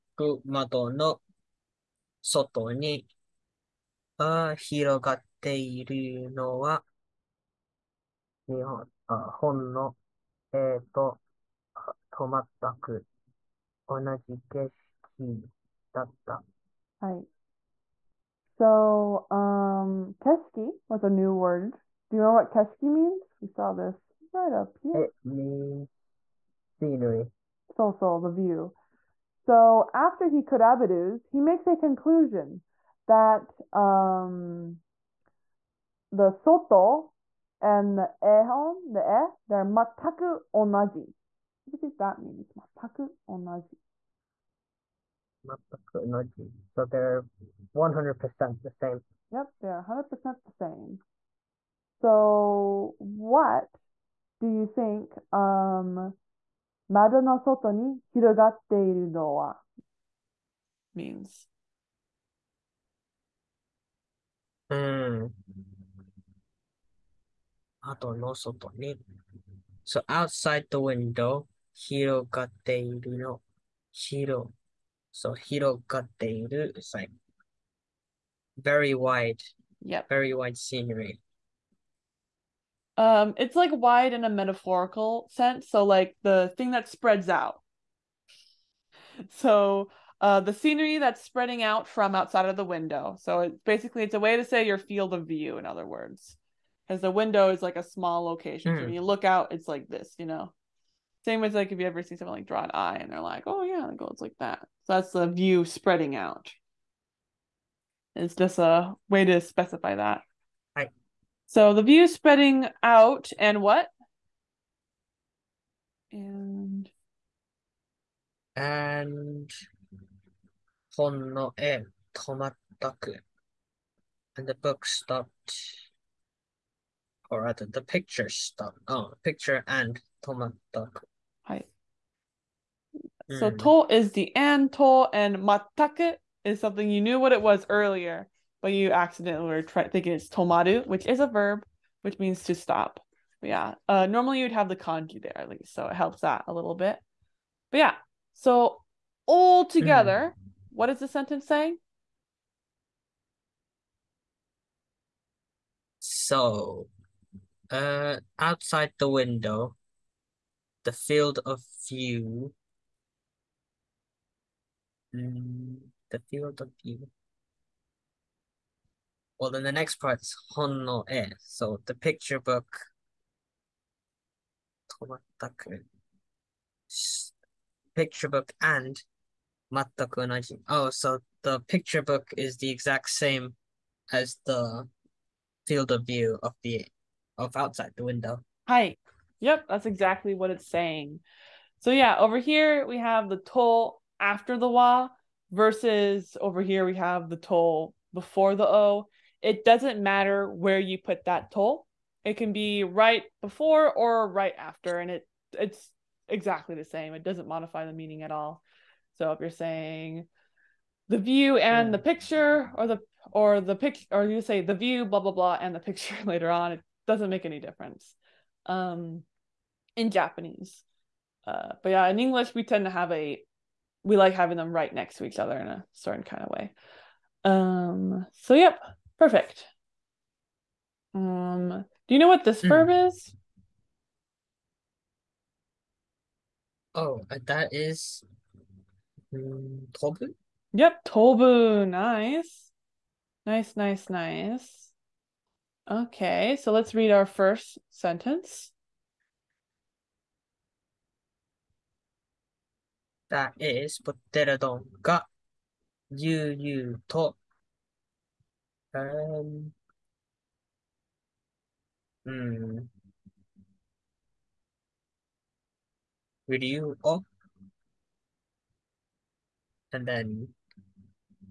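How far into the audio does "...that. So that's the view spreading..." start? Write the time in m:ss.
1:44.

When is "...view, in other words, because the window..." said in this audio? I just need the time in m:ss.
1:35.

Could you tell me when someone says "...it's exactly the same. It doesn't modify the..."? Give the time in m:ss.
3:25.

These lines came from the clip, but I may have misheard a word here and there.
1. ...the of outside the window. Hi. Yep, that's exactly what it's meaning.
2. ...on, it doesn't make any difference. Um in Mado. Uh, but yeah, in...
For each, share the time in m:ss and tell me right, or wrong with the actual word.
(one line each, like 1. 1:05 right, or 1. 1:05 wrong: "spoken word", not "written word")
1. 3:06 wrong: "saying", not "meaning"
2. 3:36 wrong: "Japanese", not "Mado".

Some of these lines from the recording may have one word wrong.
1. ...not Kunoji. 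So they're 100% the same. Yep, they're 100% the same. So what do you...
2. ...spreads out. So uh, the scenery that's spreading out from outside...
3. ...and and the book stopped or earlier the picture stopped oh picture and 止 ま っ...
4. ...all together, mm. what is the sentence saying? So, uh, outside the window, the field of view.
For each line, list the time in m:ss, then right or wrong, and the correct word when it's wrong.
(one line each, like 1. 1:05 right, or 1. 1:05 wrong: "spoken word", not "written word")
1. 0:45 right
2. 1:26 right
3. 1:58 wrong: "rather", not "earlier"
4. 2:29 right.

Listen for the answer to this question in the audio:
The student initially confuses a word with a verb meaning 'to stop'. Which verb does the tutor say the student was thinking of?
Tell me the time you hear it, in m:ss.
2:20.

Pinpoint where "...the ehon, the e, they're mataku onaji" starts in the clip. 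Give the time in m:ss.
0:37.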